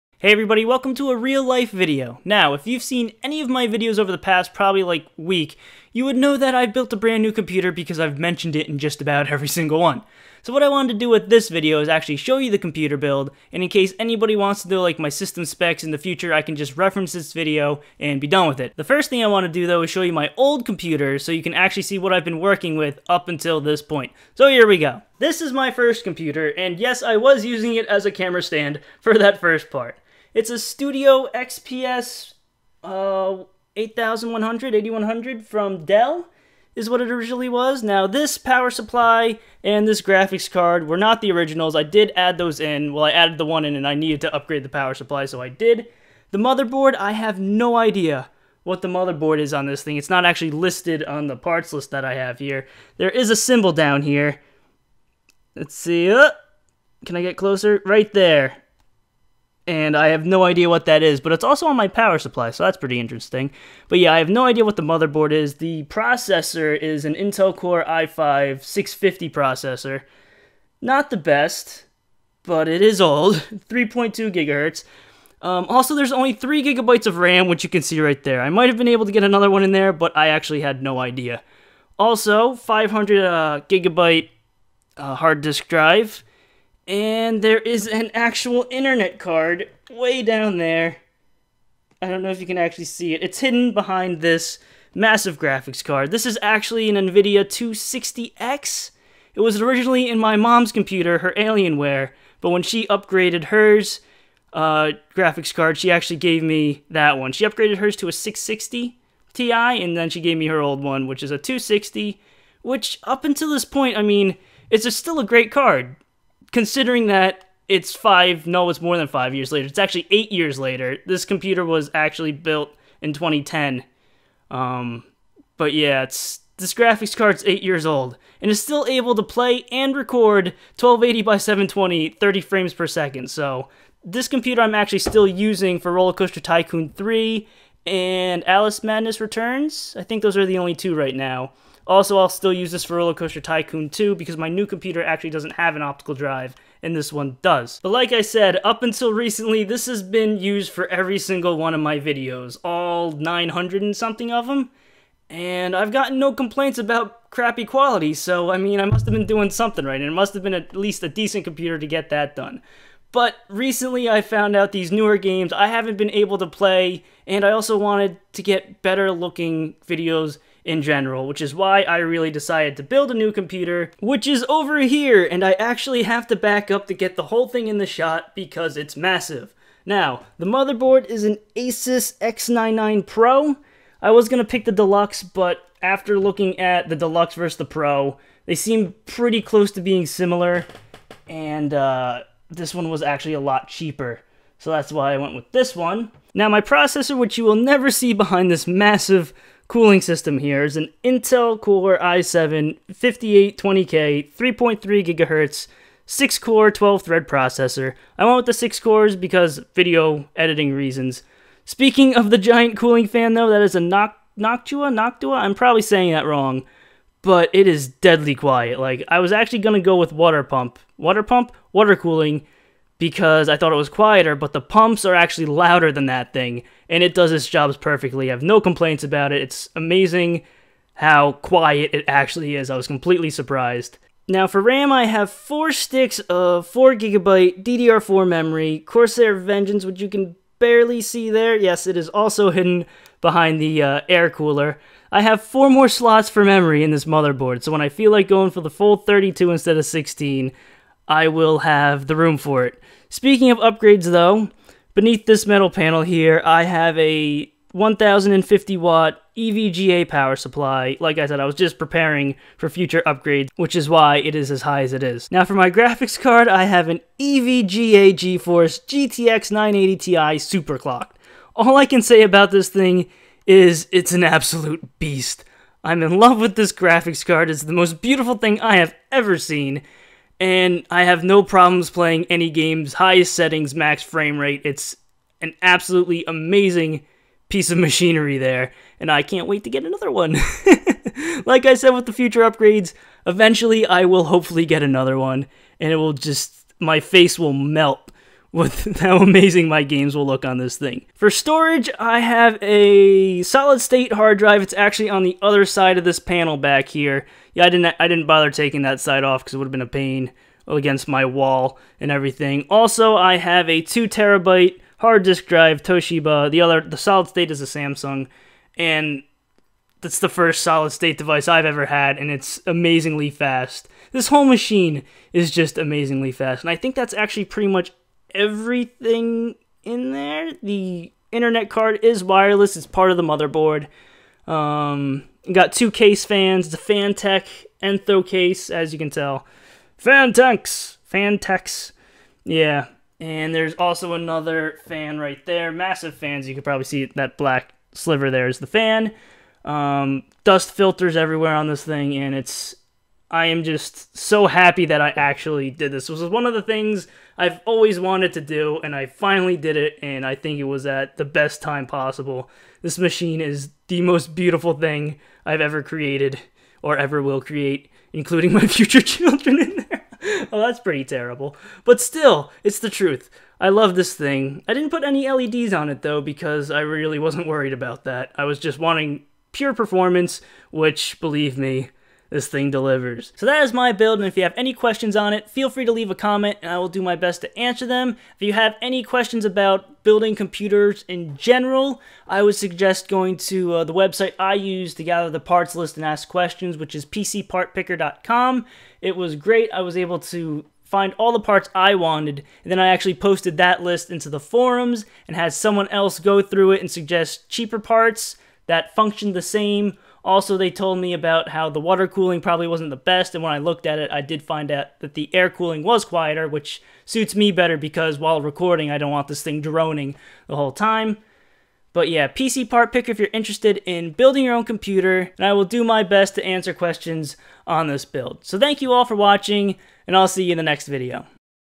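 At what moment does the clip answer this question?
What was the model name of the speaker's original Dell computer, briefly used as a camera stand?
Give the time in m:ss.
0:30.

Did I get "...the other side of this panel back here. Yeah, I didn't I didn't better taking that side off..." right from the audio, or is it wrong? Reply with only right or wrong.
wrong.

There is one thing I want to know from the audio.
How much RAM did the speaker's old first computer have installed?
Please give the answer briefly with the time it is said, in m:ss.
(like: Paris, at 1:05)
3 gigabytes, at 1:16.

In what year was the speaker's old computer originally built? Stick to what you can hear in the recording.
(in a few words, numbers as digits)
2010.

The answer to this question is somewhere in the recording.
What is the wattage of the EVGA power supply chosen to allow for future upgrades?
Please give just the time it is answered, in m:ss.
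4:17.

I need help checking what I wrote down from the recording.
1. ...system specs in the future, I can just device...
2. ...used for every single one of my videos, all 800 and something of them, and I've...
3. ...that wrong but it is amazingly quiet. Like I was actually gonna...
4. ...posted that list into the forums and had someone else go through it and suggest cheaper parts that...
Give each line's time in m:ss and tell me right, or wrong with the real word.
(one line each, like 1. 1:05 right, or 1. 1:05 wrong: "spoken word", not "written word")
1. 0:15 wrong: "reference", not "device"
2. 2:30 wrong: "900", not "800"
3. 3:36 wrong: "deadly", not "amazingly"
4. 6:43 right.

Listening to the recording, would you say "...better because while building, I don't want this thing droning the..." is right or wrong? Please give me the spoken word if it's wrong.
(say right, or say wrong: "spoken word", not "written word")
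wrong: "recording", not "building".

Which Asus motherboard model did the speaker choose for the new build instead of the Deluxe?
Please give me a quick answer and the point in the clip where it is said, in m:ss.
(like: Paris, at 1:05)
Asus X99 Pro, at 3:01.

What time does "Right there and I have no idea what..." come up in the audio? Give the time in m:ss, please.
0:57.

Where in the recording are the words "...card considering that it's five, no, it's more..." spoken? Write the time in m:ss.
1:55.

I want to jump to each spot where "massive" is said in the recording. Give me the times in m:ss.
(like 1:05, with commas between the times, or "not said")
1:34, 2:58, 3:18, 5:45.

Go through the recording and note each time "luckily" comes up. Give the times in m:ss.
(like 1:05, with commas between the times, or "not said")
not said.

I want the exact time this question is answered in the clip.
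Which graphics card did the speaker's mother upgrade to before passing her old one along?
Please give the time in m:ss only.
1:48.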